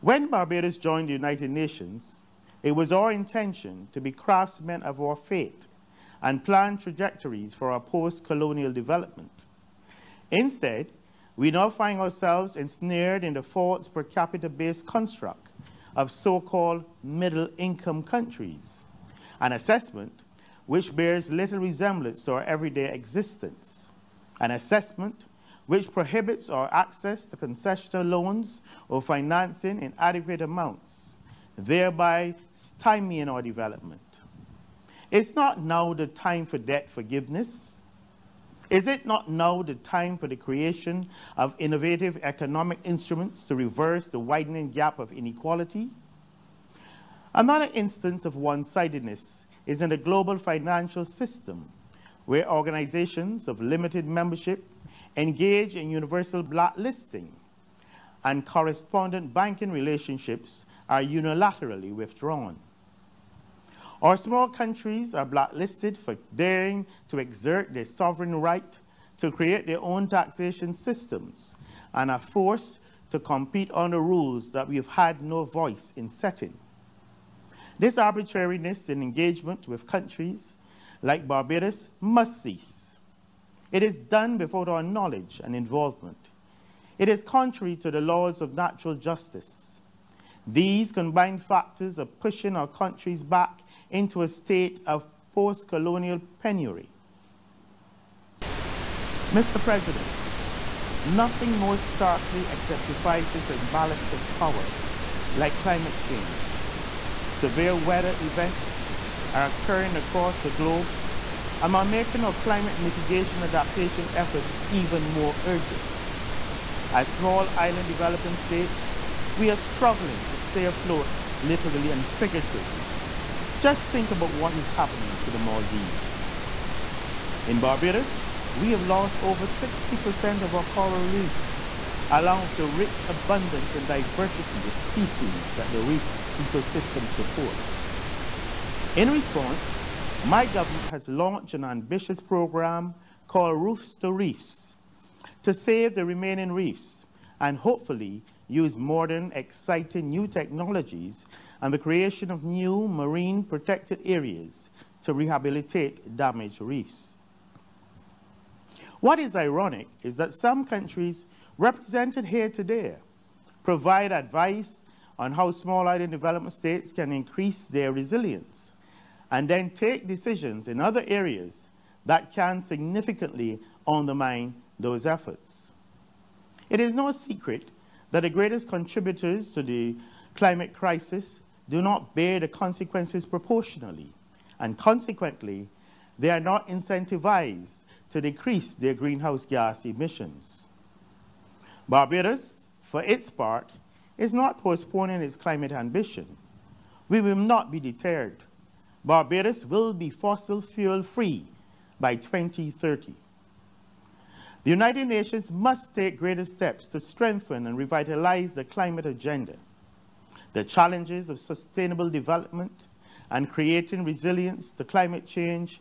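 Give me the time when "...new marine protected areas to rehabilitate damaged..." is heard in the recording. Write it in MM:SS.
02:32.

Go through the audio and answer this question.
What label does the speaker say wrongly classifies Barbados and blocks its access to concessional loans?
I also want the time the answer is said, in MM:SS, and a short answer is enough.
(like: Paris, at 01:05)
middle income countries, at 00:17.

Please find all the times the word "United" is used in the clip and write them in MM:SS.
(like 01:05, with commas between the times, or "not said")
00:01, 03:24.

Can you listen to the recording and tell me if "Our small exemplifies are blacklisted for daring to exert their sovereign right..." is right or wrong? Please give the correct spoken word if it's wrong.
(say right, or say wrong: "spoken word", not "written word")
wrong: "countries", not "exemplifies".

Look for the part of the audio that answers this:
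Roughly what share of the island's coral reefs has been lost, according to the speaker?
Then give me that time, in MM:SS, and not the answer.
02:09.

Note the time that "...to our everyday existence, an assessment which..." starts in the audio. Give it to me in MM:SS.
00:22.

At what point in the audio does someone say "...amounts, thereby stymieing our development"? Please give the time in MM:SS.
00:30.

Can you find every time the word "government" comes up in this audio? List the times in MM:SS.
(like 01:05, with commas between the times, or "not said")
02:20.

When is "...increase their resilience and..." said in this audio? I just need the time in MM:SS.
02:47.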